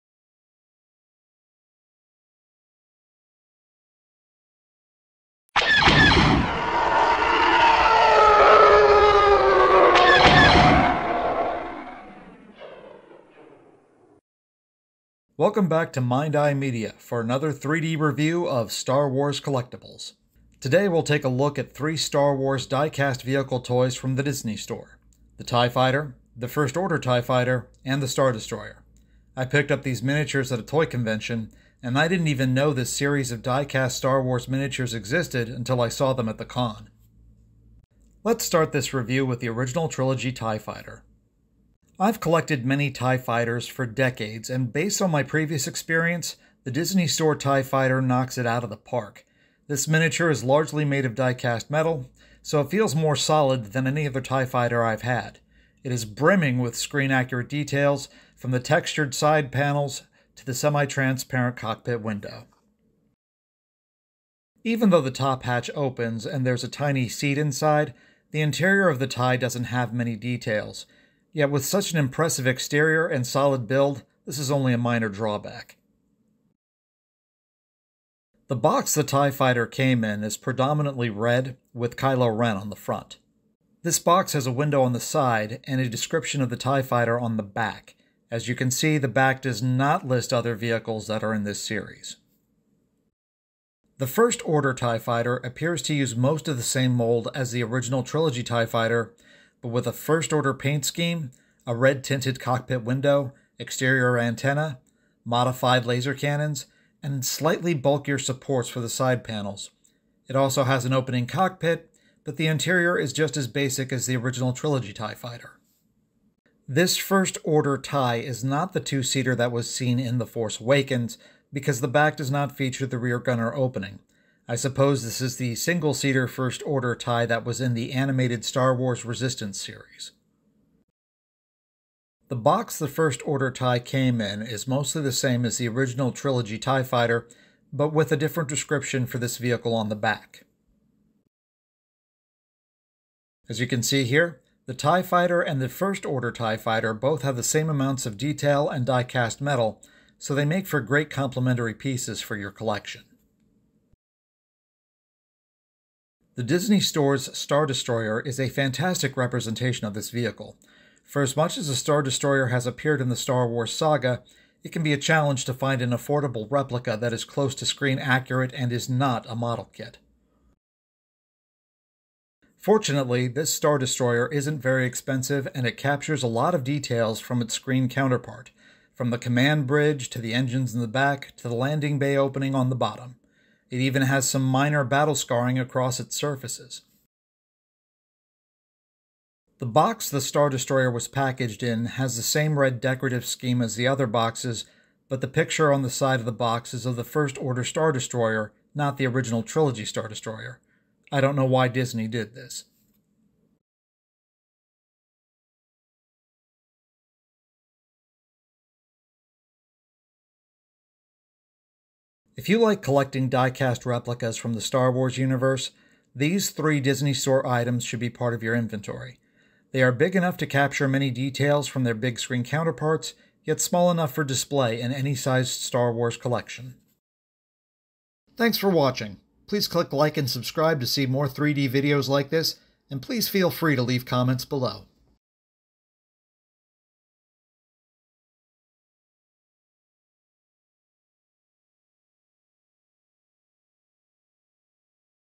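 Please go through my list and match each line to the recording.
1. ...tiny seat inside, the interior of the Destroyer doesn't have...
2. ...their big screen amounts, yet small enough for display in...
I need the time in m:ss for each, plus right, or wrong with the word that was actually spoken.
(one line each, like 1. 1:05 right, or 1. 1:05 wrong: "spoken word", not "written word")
1. 1:06 wrong: "TIE", not "Destroyer"
2. 3:41 wrong: "counterparts", not "amounts".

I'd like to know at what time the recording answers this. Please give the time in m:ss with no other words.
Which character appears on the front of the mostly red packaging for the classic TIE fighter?
1:21.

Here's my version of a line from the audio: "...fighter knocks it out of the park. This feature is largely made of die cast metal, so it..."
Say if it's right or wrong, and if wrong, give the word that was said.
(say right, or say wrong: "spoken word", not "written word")
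wrong: "miniature", not "feature".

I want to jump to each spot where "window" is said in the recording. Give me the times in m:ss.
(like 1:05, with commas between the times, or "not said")
1:02, 1:24, 1:42.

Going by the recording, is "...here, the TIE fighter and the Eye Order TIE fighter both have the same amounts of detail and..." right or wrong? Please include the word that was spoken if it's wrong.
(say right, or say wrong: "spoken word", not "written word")
wrong: "First", not "Eye".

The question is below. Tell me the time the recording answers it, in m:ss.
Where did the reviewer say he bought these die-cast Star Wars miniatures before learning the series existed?
0:30.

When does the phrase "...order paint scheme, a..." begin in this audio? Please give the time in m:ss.
1:40.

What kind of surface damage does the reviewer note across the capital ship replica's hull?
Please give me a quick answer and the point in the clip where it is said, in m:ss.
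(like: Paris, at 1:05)
Battle scarring, at 3:04.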